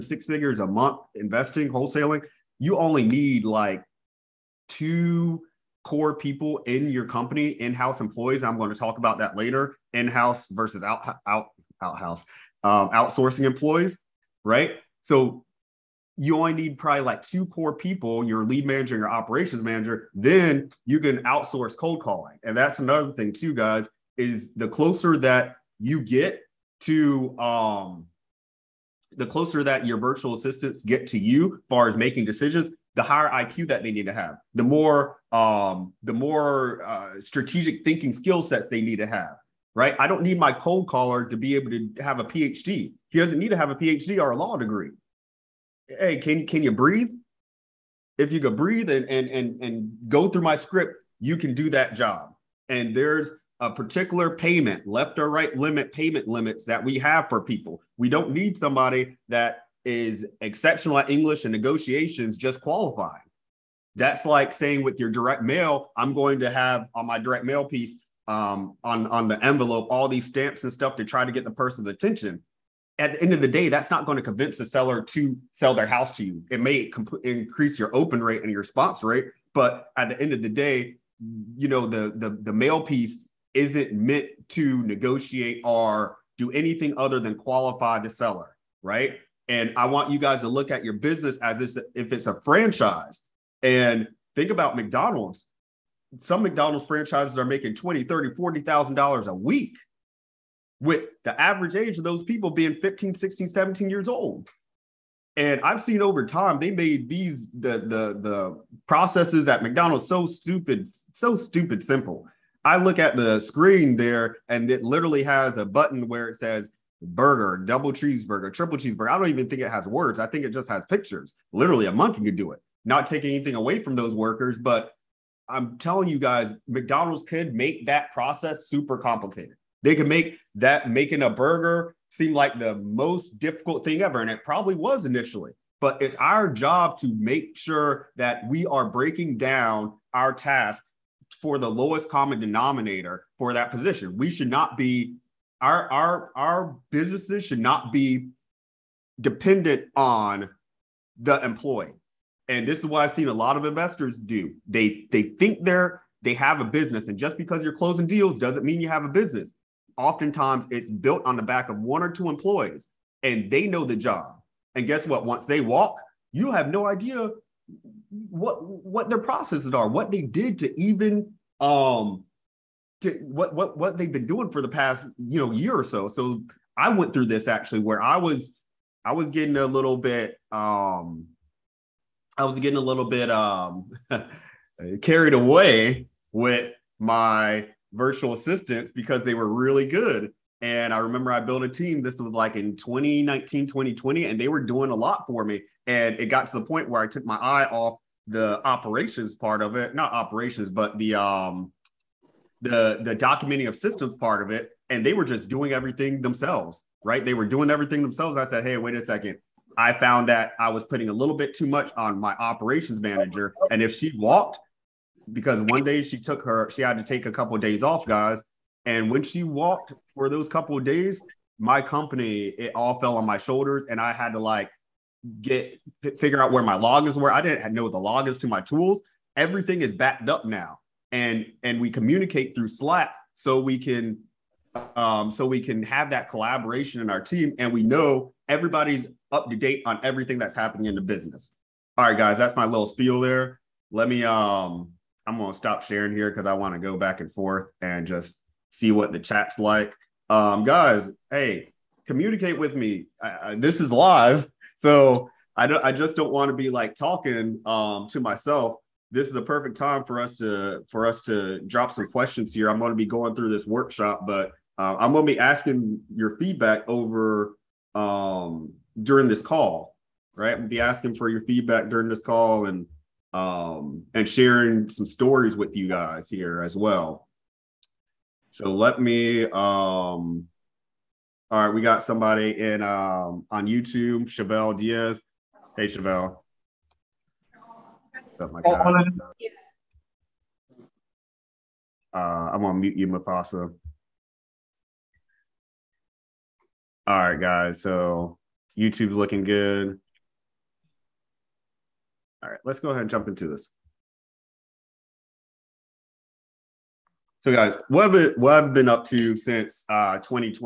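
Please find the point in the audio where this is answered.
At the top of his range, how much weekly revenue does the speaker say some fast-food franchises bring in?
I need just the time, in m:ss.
1:38.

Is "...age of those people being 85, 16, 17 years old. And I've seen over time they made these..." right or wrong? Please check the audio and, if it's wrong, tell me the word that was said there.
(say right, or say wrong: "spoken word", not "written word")
wrong: "15", not "85".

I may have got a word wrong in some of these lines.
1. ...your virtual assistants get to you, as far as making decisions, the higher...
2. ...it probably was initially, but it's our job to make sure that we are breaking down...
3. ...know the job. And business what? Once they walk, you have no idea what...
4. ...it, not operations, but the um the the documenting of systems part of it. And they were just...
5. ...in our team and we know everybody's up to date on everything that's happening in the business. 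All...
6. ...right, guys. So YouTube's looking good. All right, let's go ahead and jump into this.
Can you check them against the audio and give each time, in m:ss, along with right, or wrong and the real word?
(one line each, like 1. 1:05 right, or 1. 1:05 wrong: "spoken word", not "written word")
1. 0:29 right
2. 2:14 right
3. 2:43 wrong: "guess", not "business"
4. 3:19 right
5. 3:57 right
6. 4:57 right.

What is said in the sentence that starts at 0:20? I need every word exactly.
Then you can outsource cold calling, and that's another thing too, guys.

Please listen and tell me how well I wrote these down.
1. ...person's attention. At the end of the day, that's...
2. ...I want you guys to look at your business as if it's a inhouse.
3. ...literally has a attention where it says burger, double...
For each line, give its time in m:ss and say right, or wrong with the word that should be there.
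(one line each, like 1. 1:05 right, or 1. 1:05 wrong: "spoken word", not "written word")
1. 1:11 right
2. 1:29 wrong: "franchise", not "inhouse"
3. 1:54 wrong: "button", not "attention".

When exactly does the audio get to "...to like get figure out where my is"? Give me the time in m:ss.
3:44.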